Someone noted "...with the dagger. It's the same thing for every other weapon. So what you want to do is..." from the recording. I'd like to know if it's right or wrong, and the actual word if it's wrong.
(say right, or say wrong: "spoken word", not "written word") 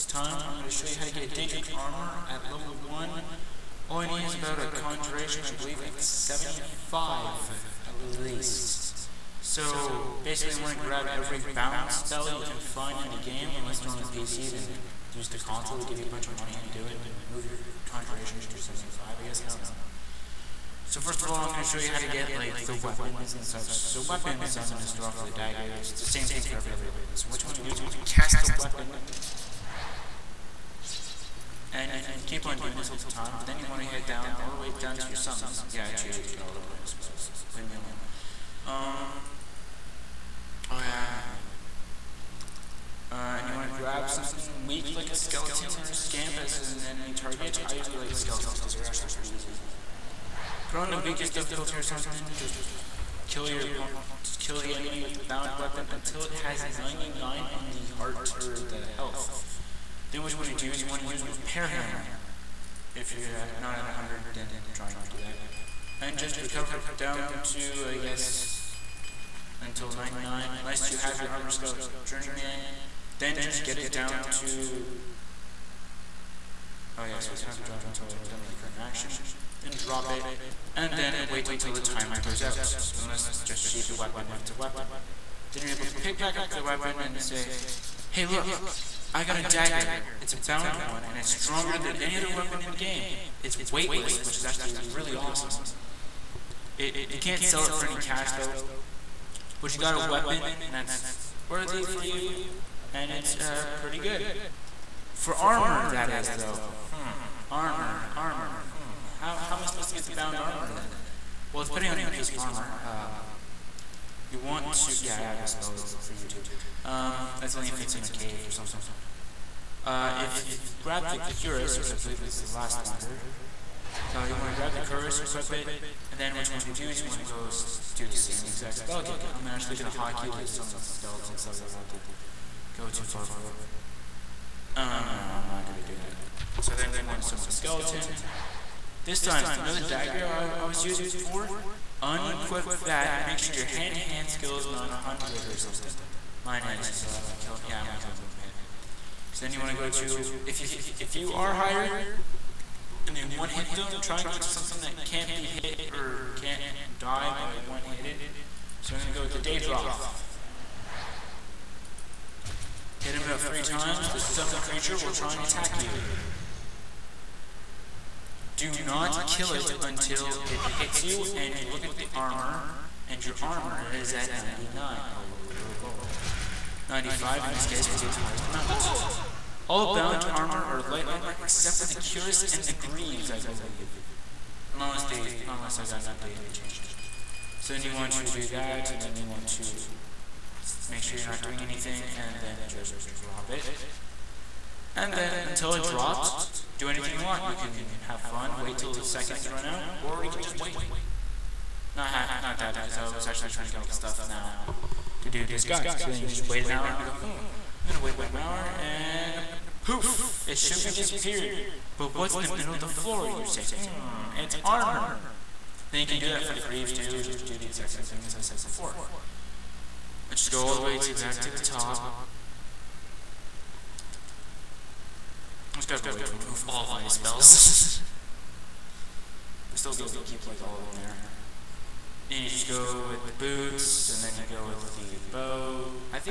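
right.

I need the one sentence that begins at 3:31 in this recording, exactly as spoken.
But what's in the middle of the floor, you say?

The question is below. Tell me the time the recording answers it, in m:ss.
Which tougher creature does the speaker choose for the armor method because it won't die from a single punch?
2:39.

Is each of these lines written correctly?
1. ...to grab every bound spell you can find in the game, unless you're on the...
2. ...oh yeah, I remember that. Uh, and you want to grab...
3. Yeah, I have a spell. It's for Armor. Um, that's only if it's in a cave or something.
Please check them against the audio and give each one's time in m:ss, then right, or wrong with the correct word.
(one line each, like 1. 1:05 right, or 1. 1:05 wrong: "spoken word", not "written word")
1. 0:10 right
2. 0:40 right
3. 1:55 wrong: "YouTube", not "Armor".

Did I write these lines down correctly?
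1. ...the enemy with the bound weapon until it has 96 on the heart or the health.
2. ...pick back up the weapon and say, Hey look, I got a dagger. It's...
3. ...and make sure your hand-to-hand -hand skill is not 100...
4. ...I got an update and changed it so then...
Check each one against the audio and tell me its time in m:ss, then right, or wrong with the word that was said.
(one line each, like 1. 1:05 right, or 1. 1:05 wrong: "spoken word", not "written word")
1. 0:54 wrong: "99", not "96"
2. 1:25 right
3. 2:23 right
4. 3:05 right.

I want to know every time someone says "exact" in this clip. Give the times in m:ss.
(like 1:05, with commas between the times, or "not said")
2:08, 3:37.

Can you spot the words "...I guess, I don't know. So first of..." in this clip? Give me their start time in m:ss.
0:19.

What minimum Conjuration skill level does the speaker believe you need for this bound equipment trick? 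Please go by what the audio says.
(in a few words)
75.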